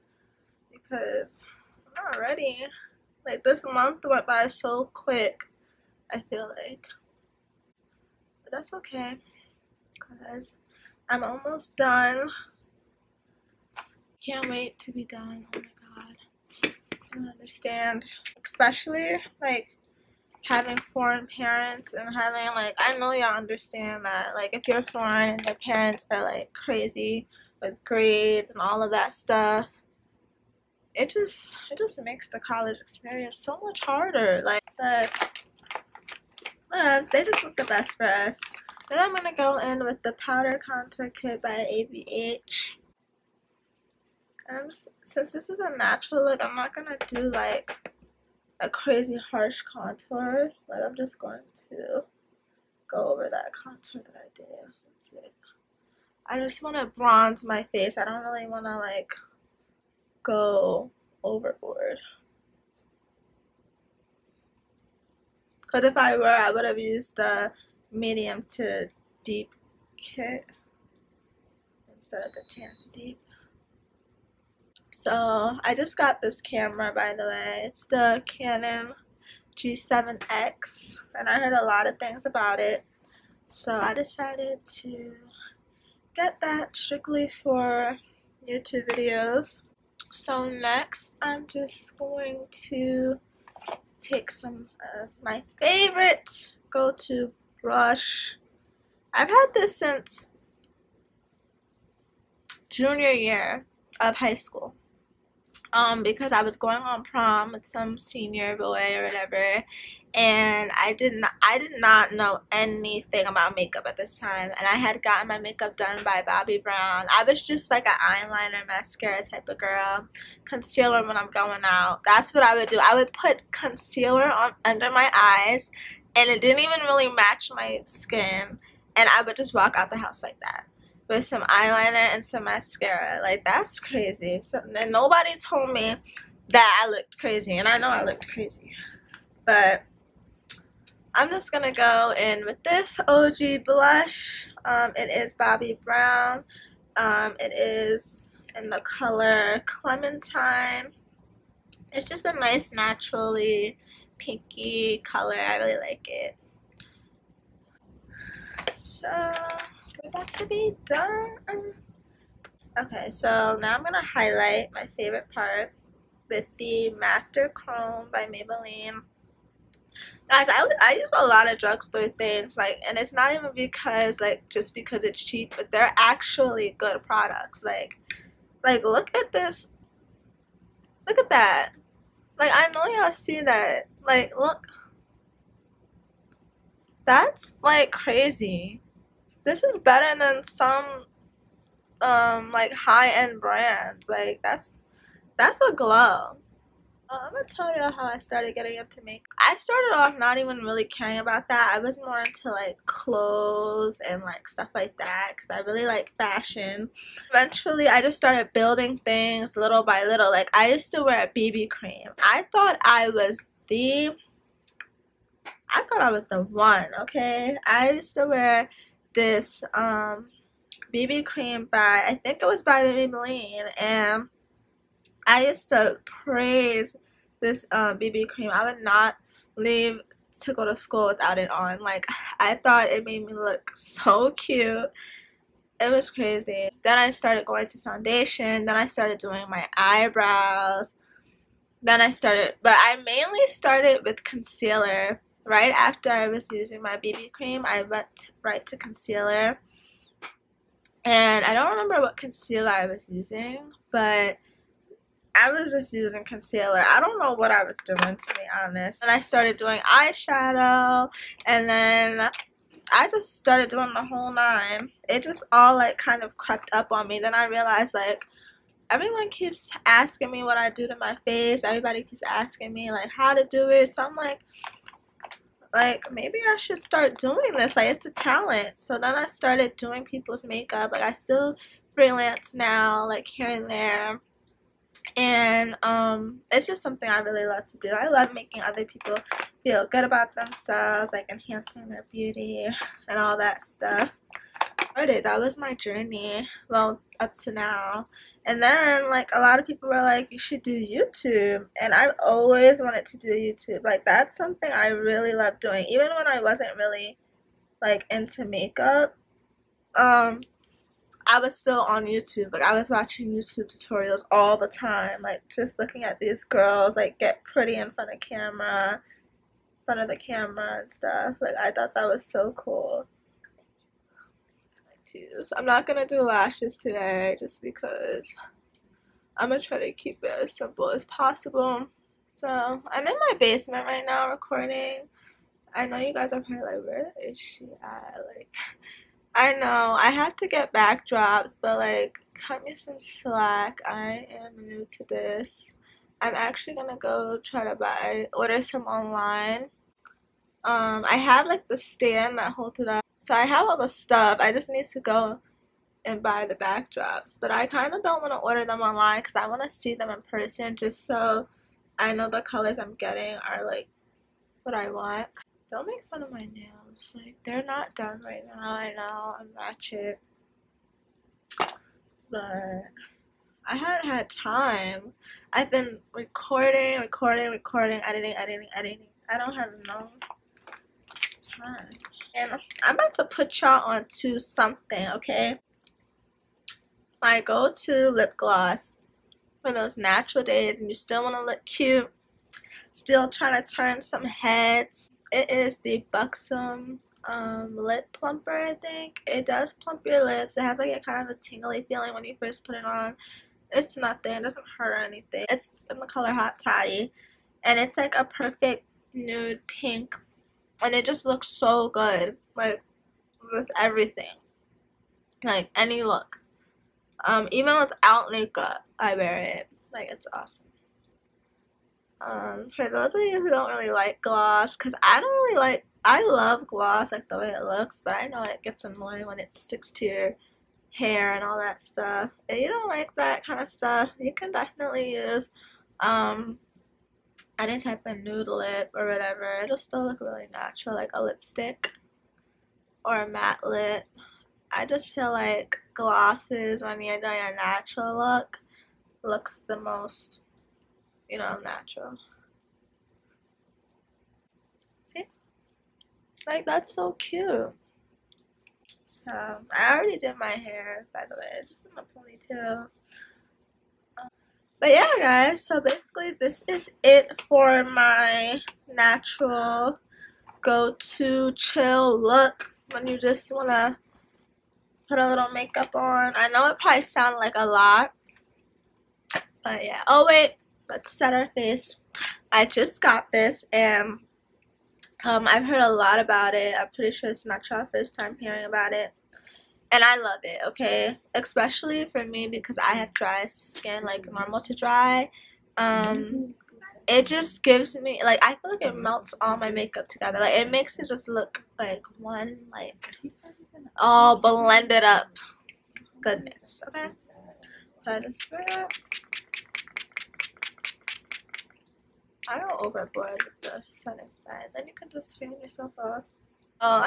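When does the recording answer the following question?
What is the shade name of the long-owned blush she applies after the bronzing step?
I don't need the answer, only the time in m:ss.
2:29.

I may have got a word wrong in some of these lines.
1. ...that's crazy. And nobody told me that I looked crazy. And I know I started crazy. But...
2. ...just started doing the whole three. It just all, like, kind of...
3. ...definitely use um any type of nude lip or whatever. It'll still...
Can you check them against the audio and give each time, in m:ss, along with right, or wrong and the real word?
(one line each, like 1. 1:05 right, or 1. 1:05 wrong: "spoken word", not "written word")
1. 2:13 wrong: "looked", not "started"
2. 4:23 wrong: "nine", not "three"
3. 7:14 right.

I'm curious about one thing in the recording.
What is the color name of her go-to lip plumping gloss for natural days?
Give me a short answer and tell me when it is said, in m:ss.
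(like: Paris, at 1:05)
Hot Toddy, at 6:46.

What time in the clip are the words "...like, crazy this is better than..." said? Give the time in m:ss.
3:07.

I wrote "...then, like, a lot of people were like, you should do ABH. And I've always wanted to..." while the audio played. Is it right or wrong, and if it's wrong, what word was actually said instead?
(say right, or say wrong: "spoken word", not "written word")
wrong: "YouTube", not "ABH".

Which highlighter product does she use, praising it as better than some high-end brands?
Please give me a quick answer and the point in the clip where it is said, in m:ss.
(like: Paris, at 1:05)
Master Chrome, at 2:46.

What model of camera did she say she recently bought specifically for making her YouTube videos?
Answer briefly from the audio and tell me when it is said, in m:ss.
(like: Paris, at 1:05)
Canon G7X, at 1:18.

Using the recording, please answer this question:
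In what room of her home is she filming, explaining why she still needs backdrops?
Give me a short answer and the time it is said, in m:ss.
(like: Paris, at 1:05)
Basement, at 5:33.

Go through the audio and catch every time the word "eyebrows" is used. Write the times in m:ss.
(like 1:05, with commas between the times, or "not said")
3:59.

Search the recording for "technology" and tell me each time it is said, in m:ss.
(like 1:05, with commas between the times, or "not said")
not said.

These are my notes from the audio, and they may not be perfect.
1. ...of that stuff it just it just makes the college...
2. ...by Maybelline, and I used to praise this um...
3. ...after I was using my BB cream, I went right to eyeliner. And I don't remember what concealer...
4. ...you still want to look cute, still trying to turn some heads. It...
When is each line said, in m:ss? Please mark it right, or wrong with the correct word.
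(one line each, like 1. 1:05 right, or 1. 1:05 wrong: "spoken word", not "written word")
1. 0:28 right
2. 3:42 right
3. 4:05 wrong: "concealer", not "eyeliner"
4. 6:30 right.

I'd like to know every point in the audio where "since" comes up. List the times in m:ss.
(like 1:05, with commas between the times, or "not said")
0:45, 1:39.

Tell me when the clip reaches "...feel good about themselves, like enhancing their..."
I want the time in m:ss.
4:49.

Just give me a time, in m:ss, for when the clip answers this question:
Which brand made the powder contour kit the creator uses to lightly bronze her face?
0:41.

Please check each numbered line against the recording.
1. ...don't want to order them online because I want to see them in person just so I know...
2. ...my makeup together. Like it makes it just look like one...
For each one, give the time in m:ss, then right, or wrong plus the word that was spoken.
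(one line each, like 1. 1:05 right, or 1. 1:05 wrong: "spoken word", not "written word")
1. 5:58 right
2. 8:19 right.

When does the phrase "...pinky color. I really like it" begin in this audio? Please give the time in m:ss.
2:34.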